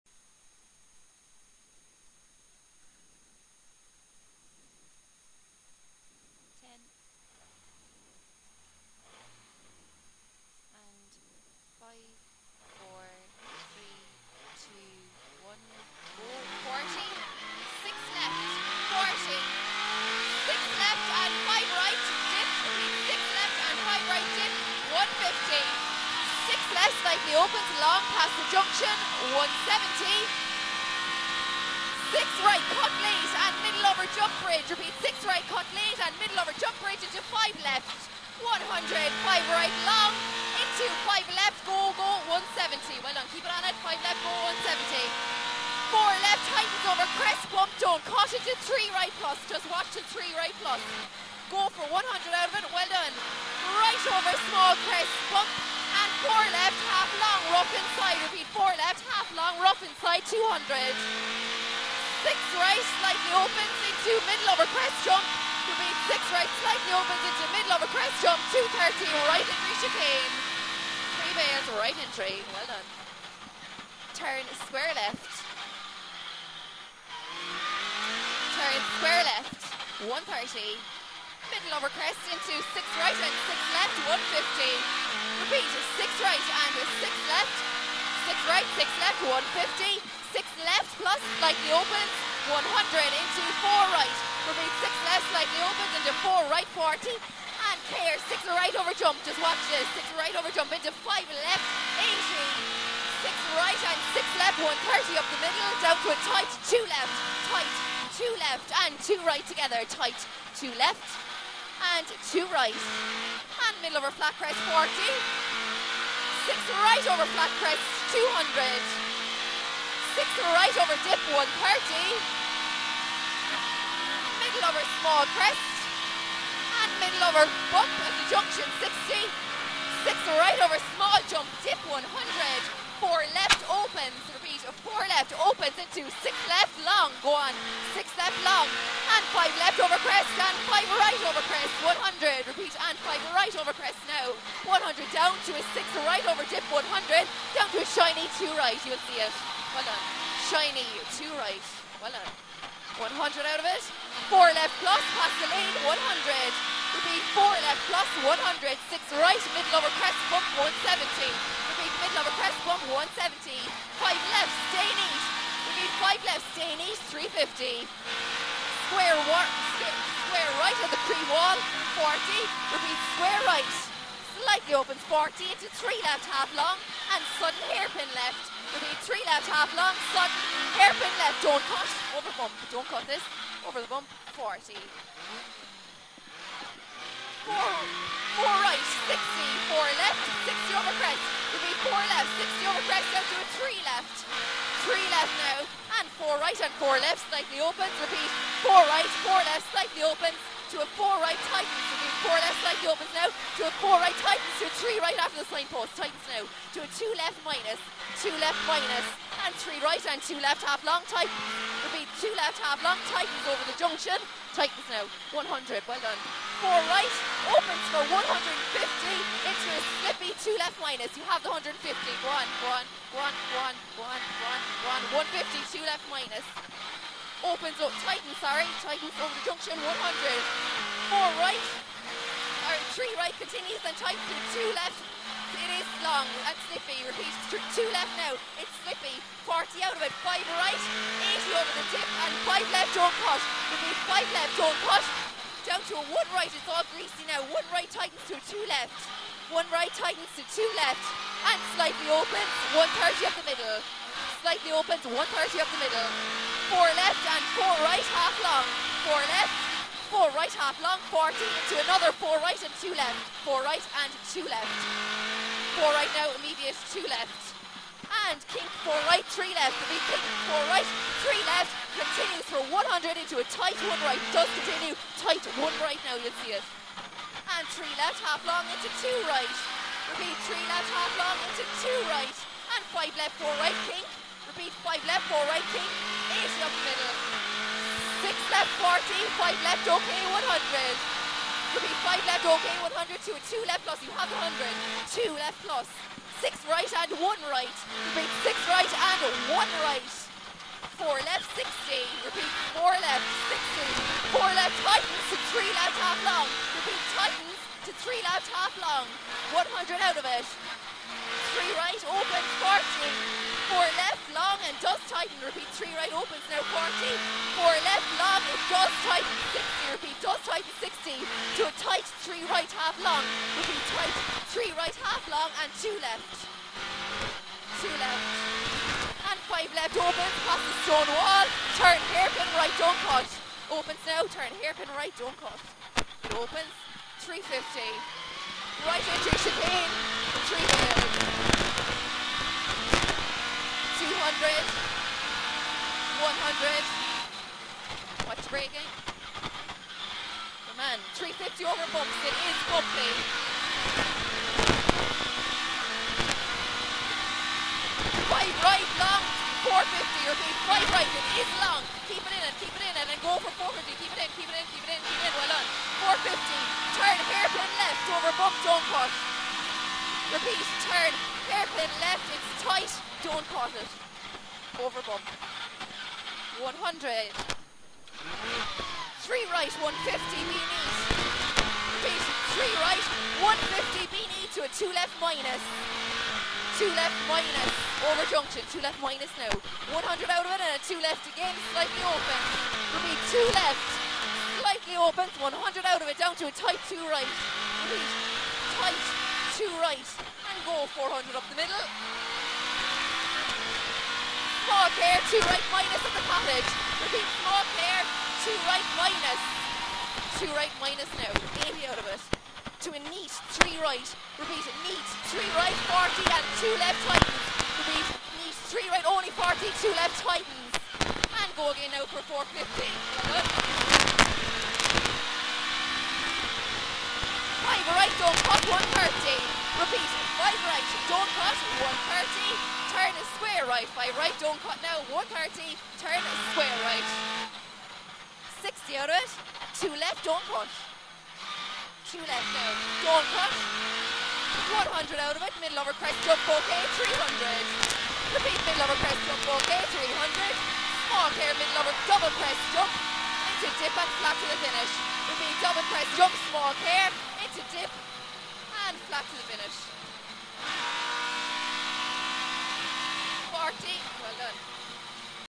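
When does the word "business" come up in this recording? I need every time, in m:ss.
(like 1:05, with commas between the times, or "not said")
not said.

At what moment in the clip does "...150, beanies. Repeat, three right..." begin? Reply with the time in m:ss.
6:19.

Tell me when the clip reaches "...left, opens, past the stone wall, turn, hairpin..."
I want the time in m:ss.
5:29.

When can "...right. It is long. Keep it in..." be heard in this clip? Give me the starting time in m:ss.
6:00.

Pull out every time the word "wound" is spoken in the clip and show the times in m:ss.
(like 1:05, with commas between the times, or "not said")
not said.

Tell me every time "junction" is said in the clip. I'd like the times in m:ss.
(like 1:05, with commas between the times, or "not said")
2:08, 3:33, 3:49, 6:28.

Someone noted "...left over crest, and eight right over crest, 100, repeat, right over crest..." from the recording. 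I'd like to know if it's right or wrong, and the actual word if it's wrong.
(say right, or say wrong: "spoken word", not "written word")
wrong: "five", not "eight".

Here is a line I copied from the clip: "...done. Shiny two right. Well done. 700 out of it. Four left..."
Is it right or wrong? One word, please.
wrong.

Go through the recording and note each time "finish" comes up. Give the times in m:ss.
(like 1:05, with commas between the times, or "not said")
7:34, 7:39.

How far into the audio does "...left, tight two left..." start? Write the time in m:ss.
1:46.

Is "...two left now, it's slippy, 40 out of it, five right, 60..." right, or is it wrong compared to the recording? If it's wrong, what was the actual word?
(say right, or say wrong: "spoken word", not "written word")
wrong: "80", not "60".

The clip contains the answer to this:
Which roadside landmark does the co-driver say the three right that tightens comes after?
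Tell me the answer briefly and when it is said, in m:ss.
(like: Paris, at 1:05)
signpost, at 3:25.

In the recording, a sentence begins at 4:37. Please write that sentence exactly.
And three left, half long into two right.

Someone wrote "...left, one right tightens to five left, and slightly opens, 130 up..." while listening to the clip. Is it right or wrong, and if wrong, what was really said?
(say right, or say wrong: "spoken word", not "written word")
wrong: "two", not "five".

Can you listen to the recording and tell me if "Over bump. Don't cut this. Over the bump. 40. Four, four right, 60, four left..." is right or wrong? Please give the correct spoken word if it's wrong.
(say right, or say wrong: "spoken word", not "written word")
right.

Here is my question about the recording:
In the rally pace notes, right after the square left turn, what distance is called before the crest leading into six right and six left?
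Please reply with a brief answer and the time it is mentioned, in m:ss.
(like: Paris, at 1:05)
130, at 1:18.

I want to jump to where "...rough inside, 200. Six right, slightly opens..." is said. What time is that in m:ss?
0:59.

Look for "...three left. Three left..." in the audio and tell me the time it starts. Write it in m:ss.
3:13.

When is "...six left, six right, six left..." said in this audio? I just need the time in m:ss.
1:27.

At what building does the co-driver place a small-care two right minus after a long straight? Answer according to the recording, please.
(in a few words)
the cottage.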